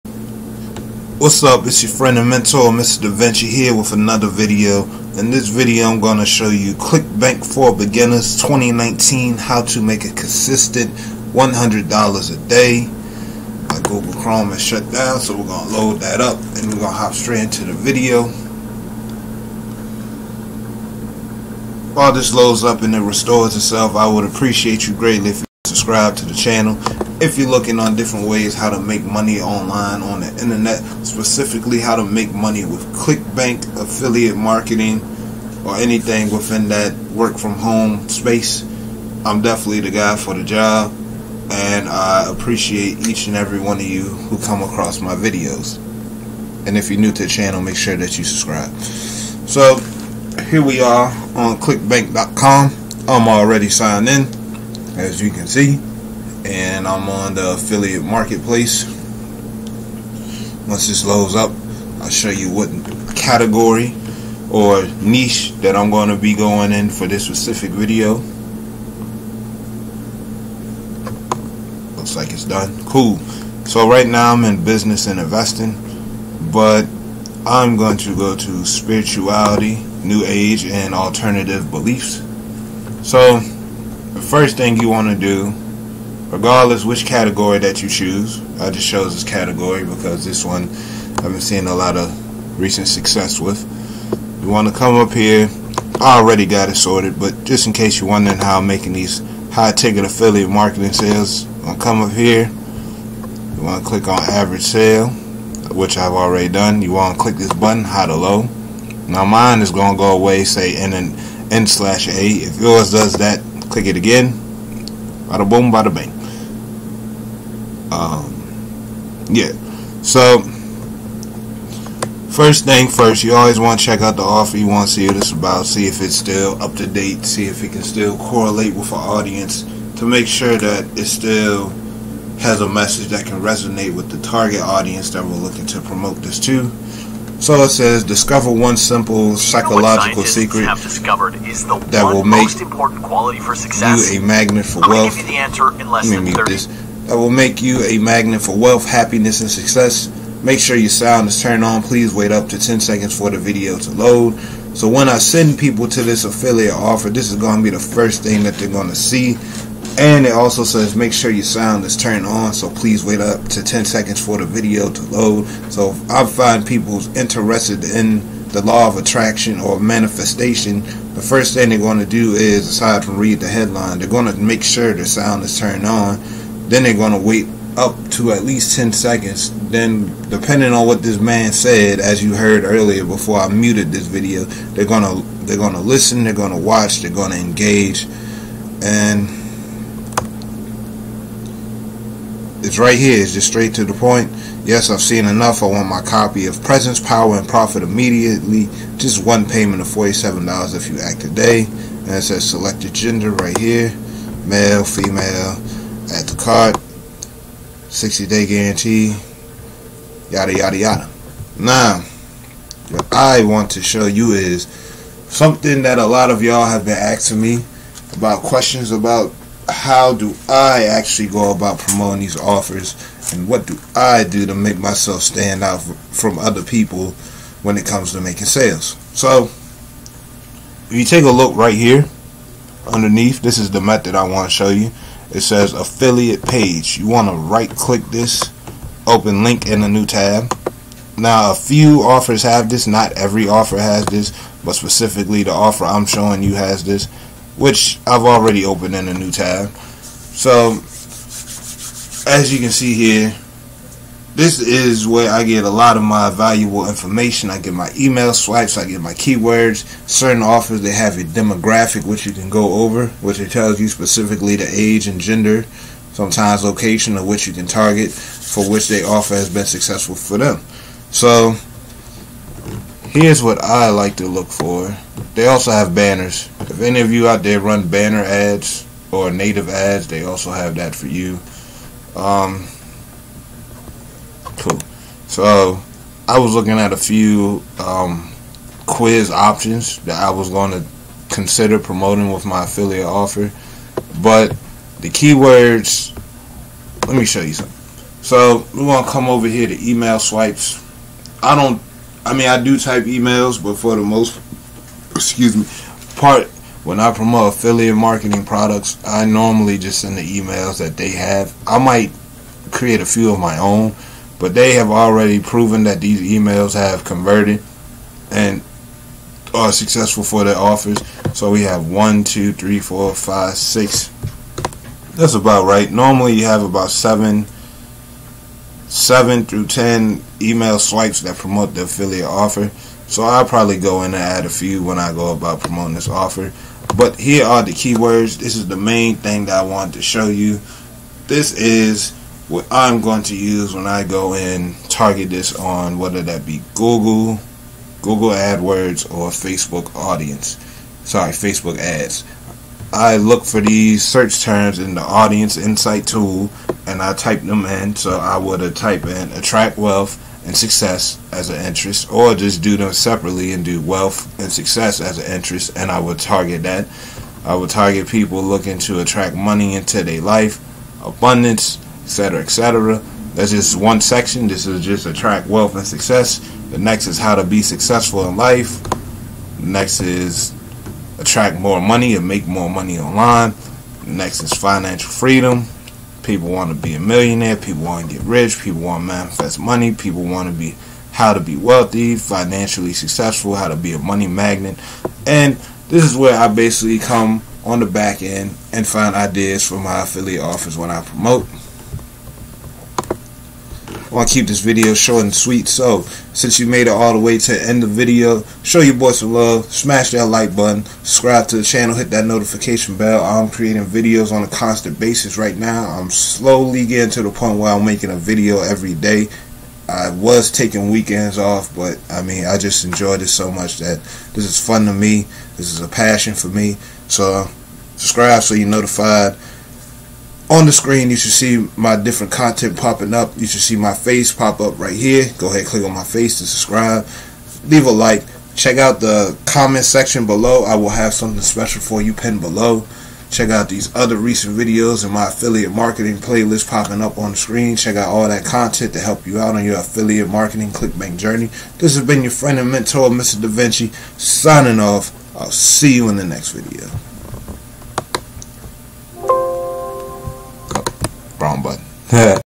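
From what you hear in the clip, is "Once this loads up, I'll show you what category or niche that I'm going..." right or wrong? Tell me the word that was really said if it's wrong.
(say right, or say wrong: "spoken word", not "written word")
right.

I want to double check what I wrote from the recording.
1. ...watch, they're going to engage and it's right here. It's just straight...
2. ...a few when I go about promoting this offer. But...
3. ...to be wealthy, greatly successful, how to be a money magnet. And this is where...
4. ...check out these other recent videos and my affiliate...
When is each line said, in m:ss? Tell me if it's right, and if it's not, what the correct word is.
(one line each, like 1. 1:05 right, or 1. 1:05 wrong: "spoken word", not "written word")
1. 3:06 right
2. 5:34 right
3. 6:31 wrong: "financially", not "greatly"
4. 7:23 right.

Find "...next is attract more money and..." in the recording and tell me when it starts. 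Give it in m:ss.
6:19.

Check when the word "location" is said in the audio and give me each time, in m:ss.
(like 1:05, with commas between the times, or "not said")
4:26.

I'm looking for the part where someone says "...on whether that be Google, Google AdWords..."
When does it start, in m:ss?
5:45.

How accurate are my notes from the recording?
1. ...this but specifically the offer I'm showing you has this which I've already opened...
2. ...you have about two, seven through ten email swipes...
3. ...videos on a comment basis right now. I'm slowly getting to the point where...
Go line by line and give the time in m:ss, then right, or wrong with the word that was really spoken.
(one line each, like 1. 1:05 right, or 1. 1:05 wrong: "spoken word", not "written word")
1. 4:04 right
2. 5:26 wrong: "seven", not "two"
3. 6:53 wrong: "constant", not "comment".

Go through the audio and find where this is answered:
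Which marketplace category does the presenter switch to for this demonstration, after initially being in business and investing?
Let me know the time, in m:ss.
1:18.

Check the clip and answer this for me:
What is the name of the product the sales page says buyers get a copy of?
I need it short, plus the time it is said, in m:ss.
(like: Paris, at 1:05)
Presence, Power, and Profit, at 3:16.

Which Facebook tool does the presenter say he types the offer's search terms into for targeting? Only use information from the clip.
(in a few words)
Audience insight tool.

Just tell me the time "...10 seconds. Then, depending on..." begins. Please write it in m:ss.
2:58.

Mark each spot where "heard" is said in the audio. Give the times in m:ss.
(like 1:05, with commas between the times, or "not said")
3:02.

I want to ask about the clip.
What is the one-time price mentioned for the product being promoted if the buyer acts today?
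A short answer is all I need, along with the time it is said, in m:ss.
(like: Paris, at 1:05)
$47, at 3:19.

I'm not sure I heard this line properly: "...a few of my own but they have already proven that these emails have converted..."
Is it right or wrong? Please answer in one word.
right.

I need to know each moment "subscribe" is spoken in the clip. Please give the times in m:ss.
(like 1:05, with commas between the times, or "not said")
0:25, 0:48, 6:50, 7:07, 7:16.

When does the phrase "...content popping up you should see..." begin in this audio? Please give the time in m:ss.
7:12.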